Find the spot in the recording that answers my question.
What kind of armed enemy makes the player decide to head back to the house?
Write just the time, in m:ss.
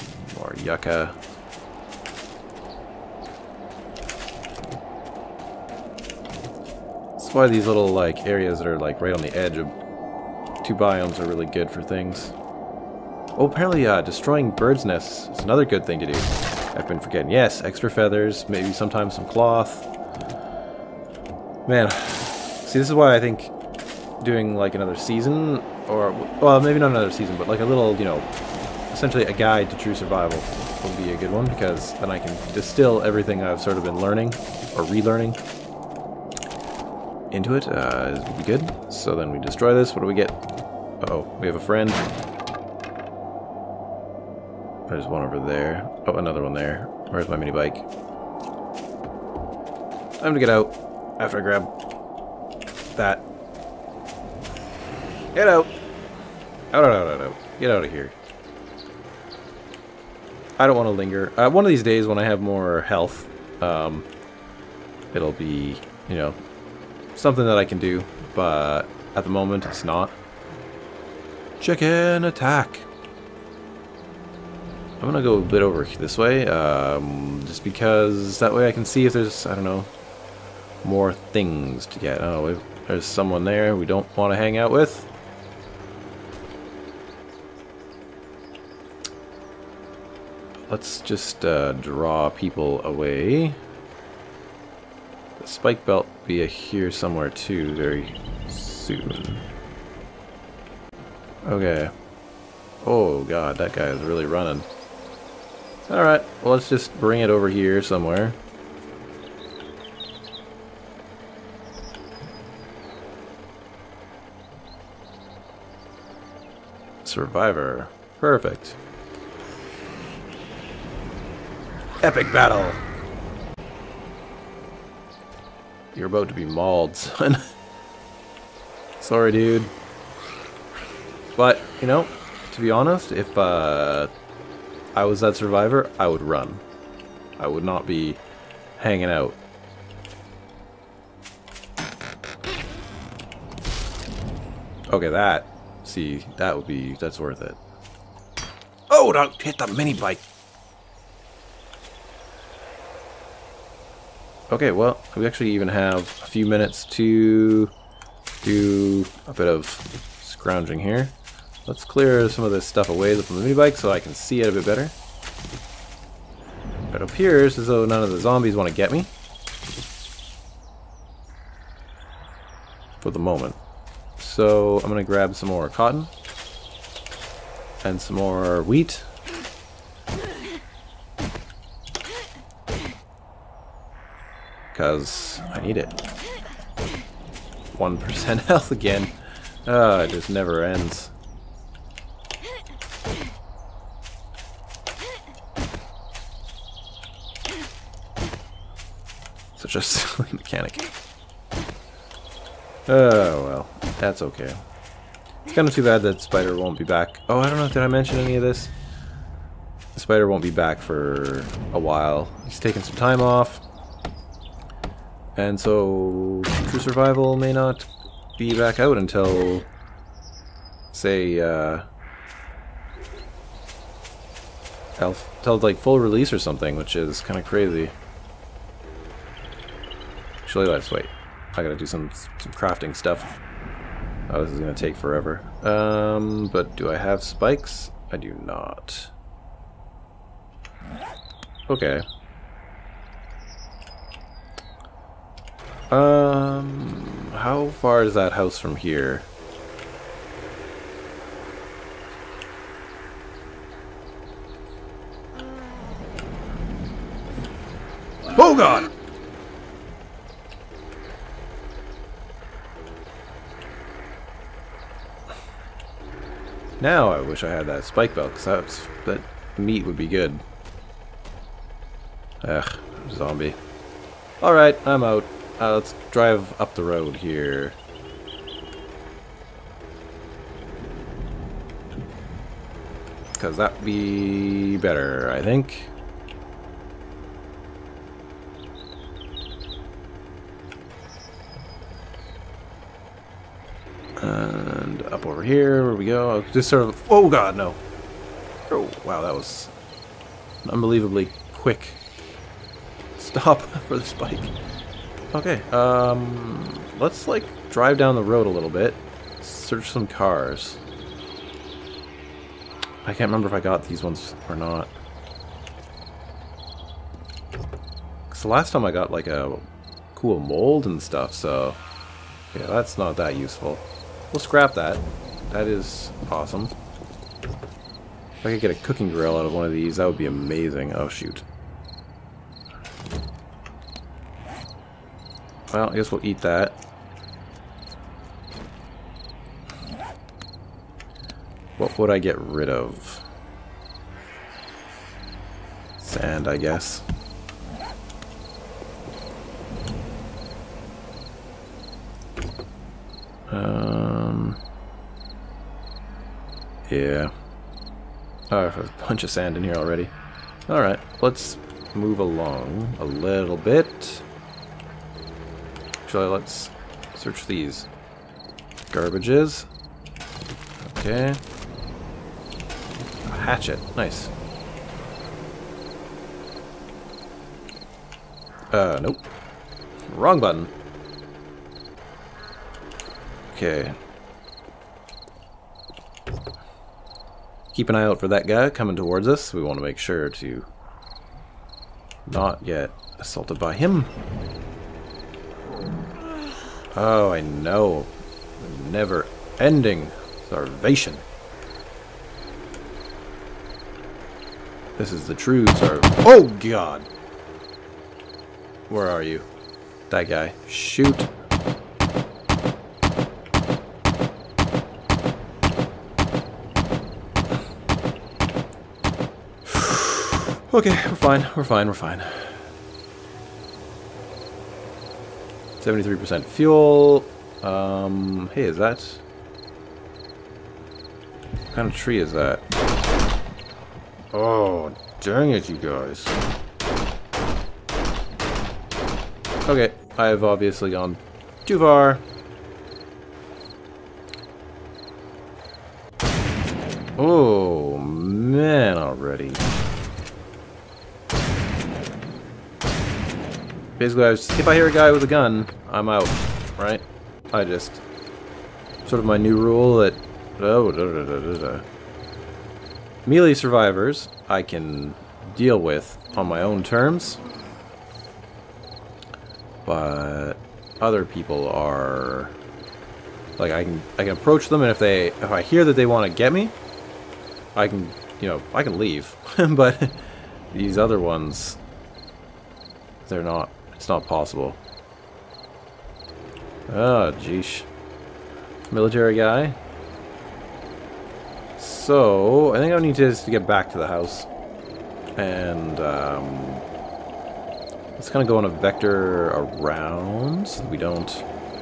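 8:08.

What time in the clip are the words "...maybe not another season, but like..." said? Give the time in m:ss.
0:26.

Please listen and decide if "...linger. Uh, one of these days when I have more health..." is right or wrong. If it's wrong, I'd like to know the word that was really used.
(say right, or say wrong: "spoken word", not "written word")
right.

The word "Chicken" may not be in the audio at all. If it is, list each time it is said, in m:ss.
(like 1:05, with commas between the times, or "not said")
1:11.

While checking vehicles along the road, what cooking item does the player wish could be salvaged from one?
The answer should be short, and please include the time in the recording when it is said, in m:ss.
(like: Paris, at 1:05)
A cooking grill, at 5:28.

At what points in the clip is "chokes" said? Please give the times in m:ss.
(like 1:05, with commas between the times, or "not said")
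not said.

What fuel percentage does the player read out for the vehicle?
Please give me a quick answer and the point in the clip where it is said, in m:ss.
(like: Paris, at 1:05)
73%, at 7:05.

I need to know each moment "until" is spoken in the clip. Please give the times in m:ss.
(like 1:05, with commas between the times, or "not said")
3:38, 3:44.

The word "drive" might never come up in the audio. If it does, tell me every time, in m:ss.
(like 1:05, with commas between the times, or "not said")
4:36, 5:07.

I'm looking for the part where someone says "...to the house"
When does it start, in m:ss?
8:13.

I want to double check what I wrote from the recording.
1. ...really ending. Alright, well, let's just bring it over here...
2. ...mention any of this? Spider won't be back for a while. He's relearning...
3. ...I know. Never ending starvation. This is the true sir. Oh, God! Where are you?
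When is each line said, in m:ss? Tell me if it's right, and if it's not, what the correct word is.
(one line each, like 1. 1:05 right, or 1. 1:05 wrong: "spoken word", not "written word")
1. 1:44 wrong: "running", not "ending"
2. 3:27 wrong: "taking", not "relearning"
3. 6:37 right.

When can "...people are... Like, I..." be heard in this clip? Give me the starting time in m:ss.
7:51.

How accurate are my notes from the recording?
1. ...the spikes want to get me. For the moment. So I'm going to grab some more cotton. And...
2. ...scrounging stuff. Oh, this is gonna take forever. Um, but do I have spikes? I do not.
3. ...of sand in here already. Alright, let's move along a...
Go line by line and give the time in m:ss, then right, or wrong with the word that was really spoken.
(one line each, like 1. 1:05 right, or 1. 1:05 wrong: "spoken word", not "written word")
1. 2:48 wrong: "zombies", not "spikes"
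2. 3:52 wrong: "crafting", not "scrounging"
3. 5:59 right.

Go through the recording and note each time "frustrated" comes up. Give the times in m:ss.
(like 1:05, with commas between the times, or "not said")
not said.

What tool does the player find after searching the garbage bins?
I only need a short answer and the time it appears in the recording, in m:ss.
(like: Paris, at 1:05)
A hatchet, at 6:13.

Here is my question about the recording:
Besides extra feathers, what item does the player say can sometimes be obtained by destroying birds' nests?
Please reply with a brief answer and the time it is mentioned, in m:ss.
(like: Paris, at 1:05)
Cloth, at 0:19.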